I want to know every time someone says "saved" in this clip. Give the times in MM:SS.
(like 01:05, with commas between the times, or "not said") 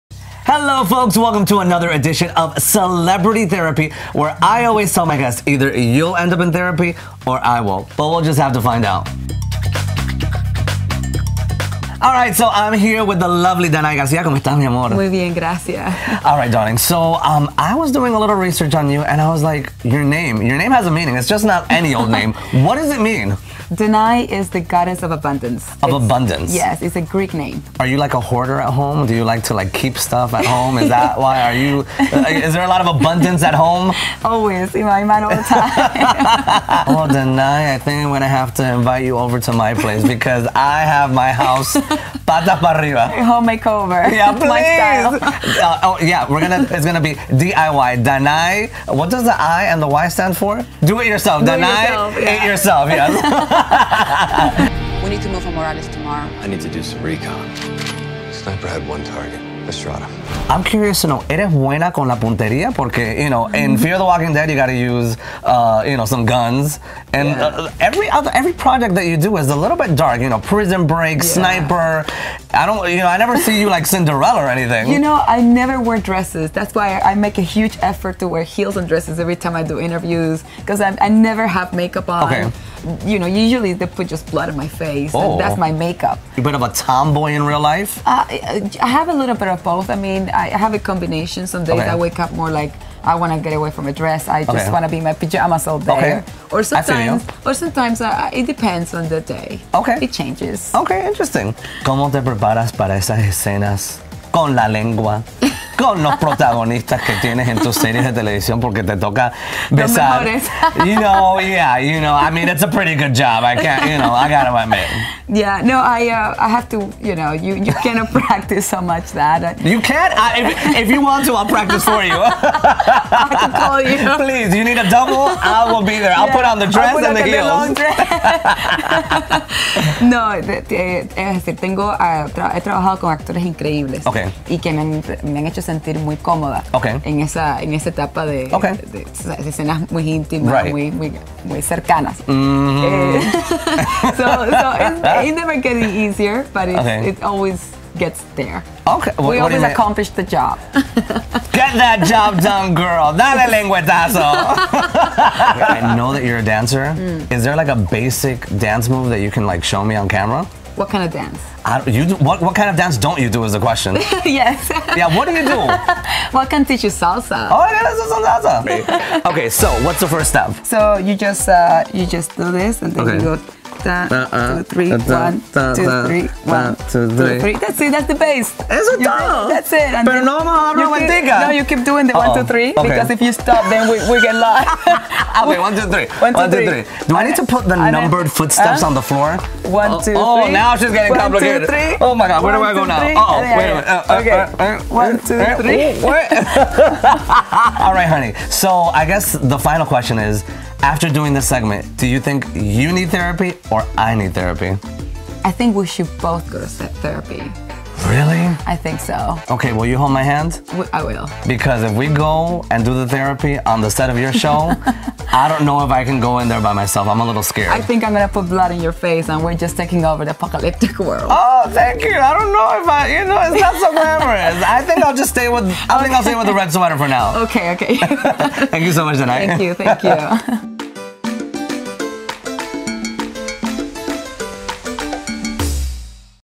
not said.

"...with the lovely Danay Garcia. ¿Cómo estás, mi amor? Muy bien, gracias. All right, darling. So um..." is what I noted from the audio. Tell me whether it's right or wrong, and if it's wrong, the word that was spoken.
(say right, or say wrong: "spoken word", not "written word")
right.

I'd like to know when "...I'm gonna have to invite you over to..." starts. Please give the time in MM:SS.
00:38.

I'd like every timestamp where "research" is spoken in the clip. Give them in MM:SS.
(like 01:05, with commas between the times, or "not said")
00:18.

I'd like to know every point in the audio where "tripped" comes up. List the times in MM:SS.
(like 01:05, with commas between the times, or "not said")
not said.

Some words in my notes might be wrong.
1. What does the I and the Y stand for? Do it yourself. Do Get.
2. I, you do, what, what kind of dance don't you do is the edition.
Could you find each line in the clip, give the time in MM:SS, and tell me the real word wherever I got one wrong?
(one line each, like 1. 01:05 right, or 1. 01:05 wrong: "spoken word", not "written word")
1. 00:48 wrong: "Danay", not "Get"
2. 02:41 wrong: "question", not "edition".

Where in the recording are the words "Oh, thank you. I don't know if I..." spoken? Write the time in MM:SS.
03:41.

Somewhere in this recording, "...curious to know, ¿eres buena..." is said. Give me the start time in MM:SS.
01:00.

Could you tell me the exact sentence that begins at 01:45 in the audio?
con los protagonistas que tienes en tus series de televisión porque te toca besar.